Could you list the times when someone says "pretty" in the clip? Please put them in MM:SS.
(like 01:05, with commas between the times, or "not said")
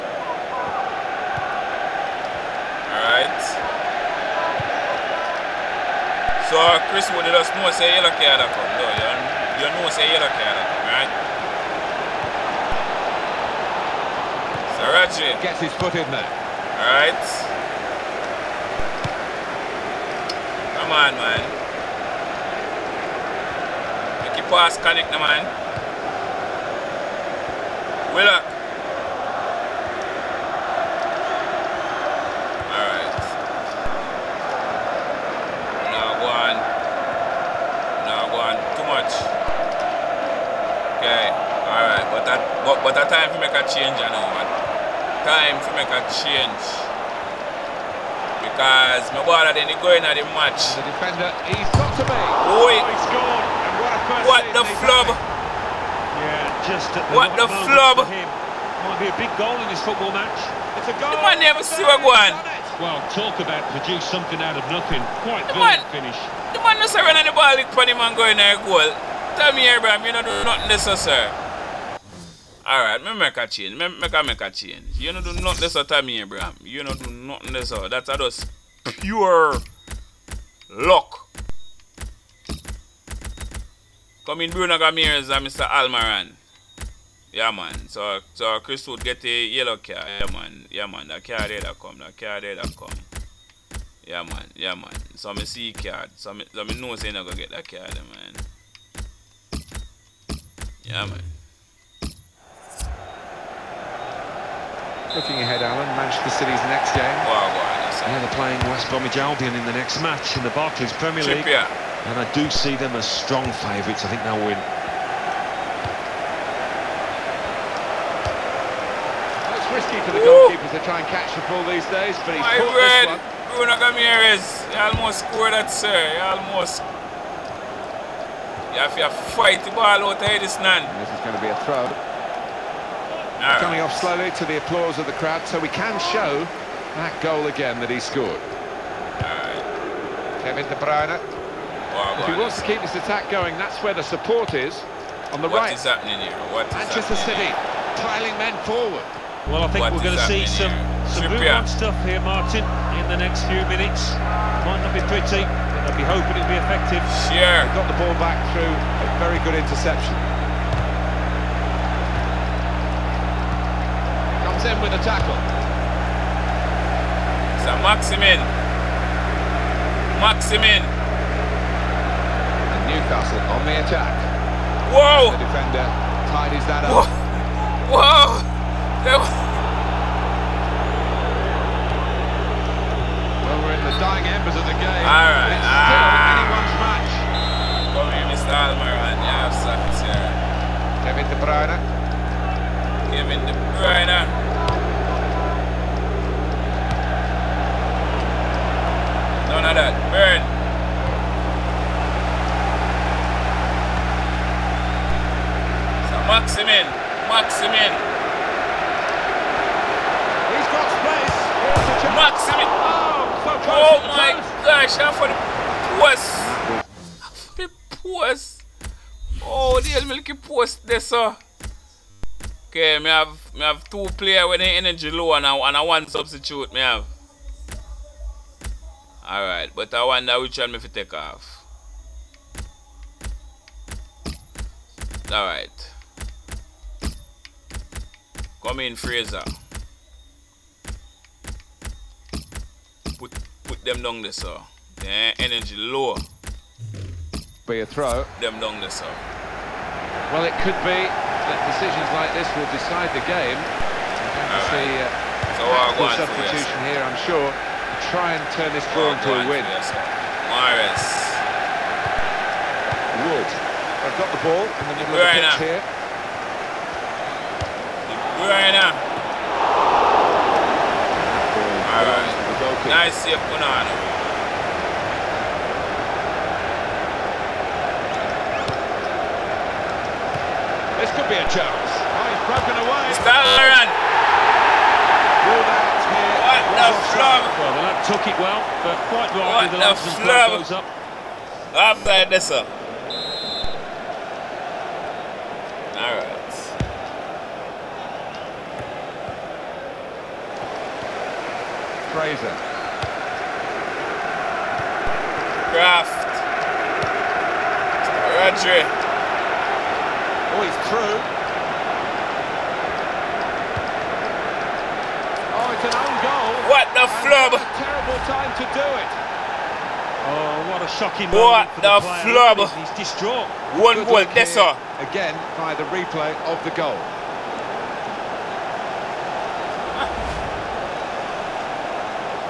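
02:35.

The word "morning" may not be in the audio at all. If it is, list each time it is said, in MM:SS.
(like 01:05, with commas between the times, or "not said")
not said.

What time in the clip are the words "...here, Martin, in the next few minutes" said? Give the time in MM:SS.
02:32.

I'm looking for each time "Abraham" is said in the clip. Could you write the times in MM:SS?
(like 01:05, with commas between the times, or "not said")
01:09, 01:16.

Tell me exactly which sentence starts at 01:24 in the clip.
Come in Bruno Gamirez and Mr.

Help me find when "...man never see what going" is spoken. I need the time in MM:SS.
01:01.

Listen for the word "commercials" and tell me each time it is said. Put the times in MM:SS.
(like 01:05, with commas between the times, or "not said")
not said.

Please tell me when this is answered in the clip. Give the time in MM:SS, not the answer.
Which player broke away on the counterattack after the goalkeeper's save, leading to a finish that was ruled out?
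04:43.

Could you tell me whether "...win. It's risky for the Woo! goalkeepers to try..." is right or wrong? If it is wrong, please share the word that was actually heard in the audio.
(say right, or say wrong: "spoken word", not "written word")
right.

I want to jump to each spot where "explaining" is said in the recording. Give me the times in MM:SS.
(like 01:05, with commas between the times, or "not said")
not said.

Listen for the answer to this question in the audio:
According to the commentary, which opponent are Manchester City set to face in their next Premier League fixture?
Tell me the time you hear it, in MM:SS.
01:48.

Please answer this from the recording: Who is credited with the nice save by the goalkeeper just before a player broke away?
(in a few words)
Bonano.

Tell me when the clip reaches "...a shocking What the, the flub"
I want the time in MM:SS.
05:20.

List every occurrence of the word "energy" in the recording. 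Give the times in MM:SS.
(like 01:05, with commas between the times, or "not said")
03:44, 04:05.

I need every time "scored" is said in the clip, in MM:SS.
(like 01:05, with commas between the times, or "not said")
00:53, 02:05, 02:18.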